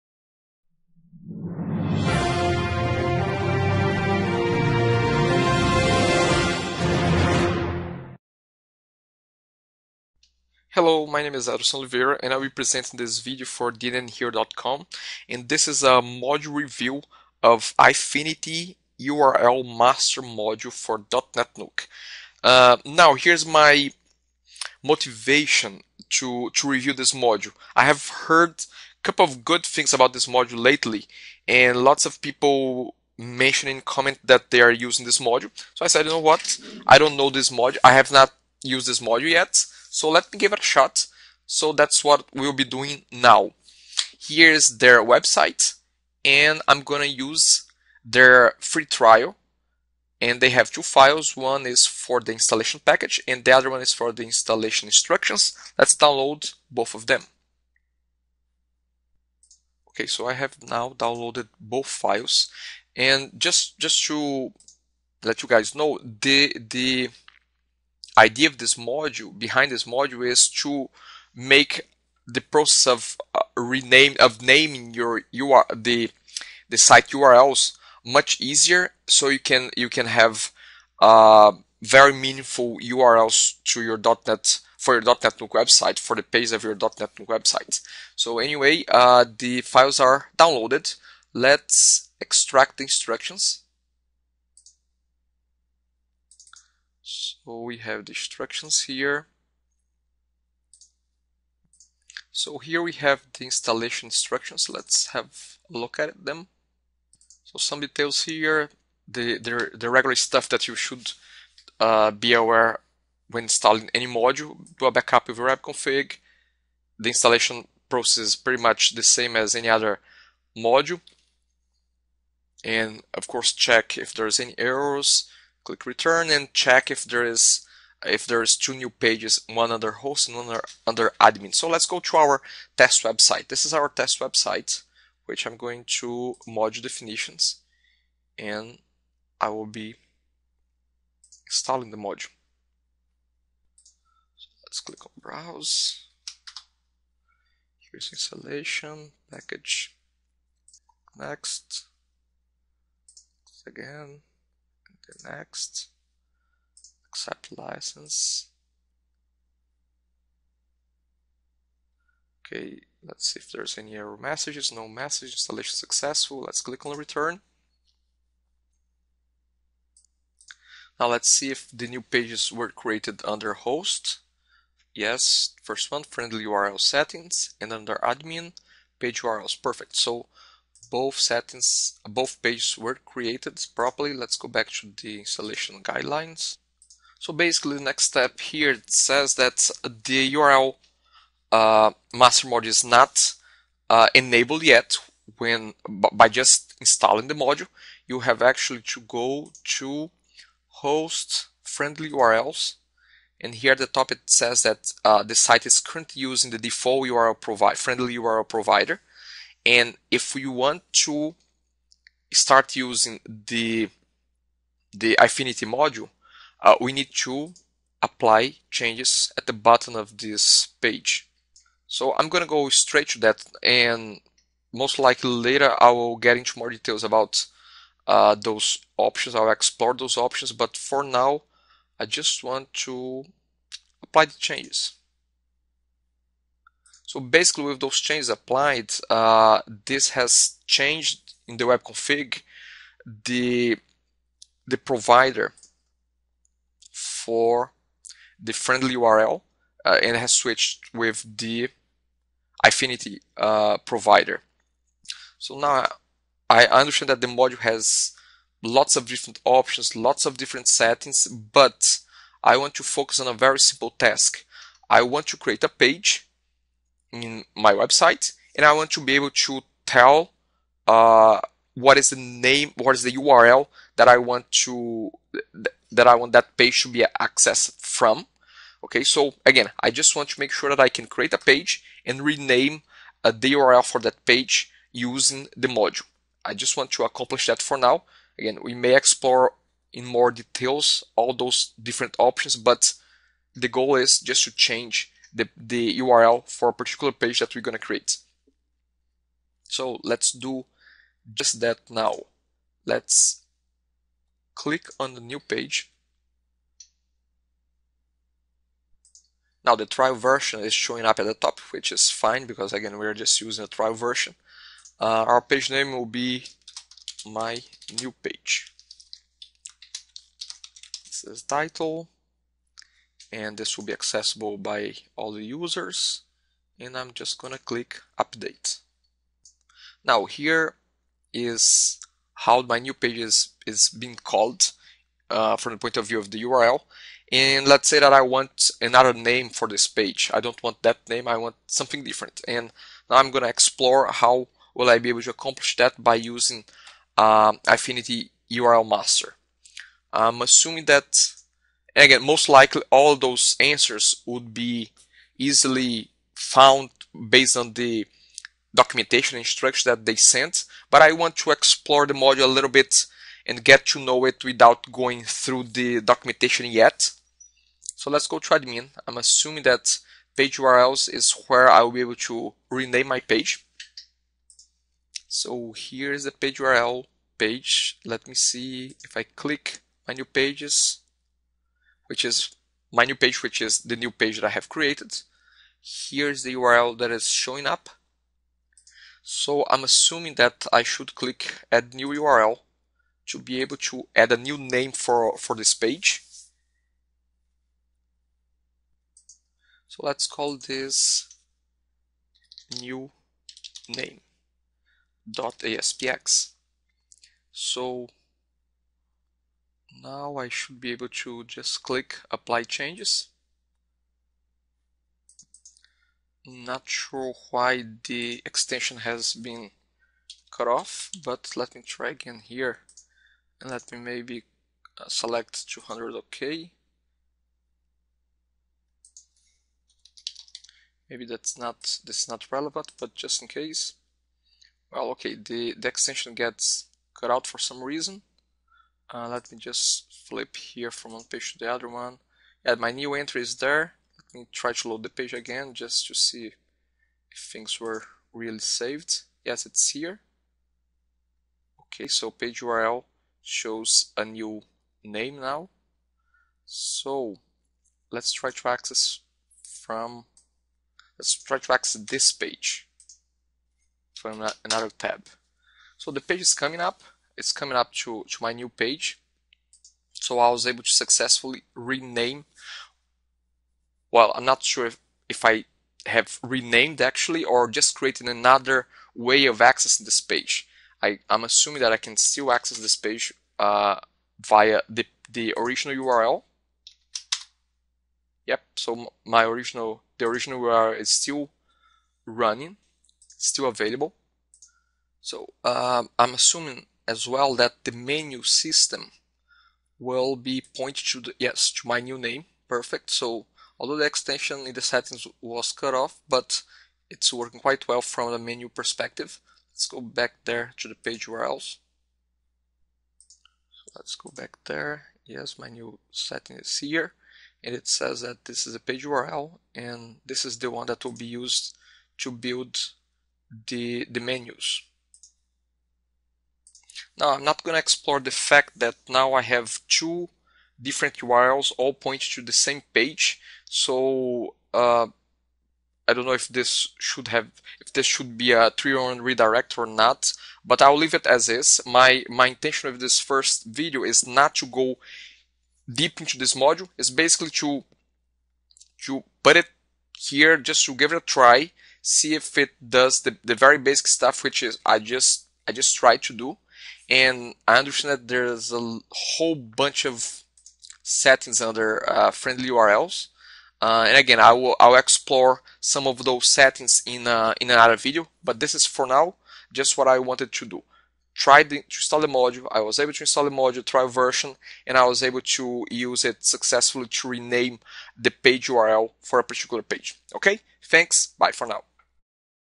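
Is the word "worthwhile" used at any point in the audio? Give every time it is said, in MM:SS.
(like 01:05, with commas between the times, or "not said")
not said.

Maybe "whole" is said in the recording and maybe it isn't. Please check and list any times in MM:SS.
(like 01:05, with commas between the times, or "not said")
09:19.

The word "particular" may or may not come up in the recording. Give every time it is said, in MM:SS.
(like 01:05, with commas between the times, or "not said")
04:56, 09:39.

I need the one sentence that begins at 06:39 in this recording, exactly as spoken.
So let's call this new name dot aspx.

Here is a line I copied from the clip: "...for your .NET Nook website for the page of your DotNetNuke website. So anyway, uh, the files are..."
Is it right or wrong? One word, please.
right.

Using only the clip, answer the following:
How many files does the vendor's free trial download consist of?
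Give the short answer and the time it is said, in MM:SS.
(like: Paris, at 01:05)
2, at 00:50.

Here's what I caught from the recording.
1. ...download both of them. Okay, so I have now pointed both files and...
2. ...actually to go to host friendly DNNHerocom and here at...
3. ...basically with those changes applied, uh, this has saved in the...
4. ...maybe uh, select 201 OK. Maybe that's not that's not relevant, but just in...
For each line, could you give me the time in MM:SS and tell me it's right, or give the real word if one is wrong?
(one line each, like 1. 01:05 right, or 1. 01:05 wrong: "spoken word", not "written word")
1. 00:55 wrong: "downloaded", not "pointed"
2. 03:18 wrong: "URLs", not "DNNHerocom"
3. 03:57 wrong: "changed", not "saved"
4. 07:03 wrong: "200", not "201".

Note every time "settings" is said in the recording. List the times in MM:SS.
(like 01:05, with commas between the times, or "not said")
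02:56, 03:01, 04:20, 08:24, 08:36, 09:21, 09:26.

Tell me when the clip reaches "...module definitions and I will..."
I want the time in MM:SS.
02:16.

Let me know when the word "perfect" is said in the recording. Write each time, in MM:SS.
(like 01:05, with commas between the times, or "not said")
02:59, 08:22.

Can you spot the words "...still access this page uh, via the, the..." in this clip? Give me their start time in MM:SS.
08:02.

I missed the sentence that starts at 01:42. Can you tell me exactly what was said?
So here we have the installation instructions.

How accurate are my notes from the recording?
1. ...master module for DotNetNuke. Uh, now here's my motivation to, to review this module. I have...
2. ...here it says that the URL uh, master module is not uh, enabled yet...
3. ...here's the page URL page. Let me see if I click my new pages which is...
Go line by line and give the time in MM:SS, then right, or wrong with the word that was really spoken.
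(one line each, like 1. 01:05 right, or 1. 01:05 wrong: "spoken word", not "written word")
1. 00:19 right
2. 03:08 right
3. 06:15 right.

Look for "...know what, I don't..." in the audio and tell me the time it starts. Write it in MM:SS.
00:36.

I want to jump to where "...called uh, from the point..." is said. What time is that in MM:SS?
05:34.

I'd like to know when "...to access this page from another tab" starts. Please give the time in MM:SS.
07:41.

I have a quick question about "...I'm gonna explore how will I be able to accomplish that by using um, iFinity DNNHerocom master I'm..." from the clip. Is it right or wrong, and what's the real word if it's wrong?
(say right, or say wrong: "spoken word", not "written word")
wrong: "URL", not "DNNHerocom".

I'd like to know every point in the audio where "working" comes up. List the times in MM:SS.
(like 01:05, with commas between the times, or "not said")
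08:27.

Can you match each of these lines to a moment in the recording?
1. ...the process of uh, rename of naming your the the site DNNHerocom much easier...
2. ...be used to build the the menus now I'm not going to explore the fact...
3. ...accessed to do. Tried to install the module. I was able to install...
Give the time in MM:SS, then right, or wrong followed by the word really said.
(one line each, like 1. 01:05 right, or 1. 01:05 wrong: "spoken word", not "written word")
1. 01:12 wrong: "URLs", not "DNNHerocom"
2. 08:41 right
3. 09:30 wrong: "wanted", not "accessed".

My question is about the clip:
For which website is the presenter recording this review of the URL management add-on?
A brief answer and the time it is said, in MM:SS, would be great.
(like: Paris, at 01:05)
DNNHero.com, at 00:13.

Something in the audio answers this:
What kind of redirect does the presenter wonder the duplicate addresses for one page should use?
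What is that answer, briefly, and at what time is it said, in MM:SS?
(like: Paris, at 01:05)
301 redirect, at 08:58.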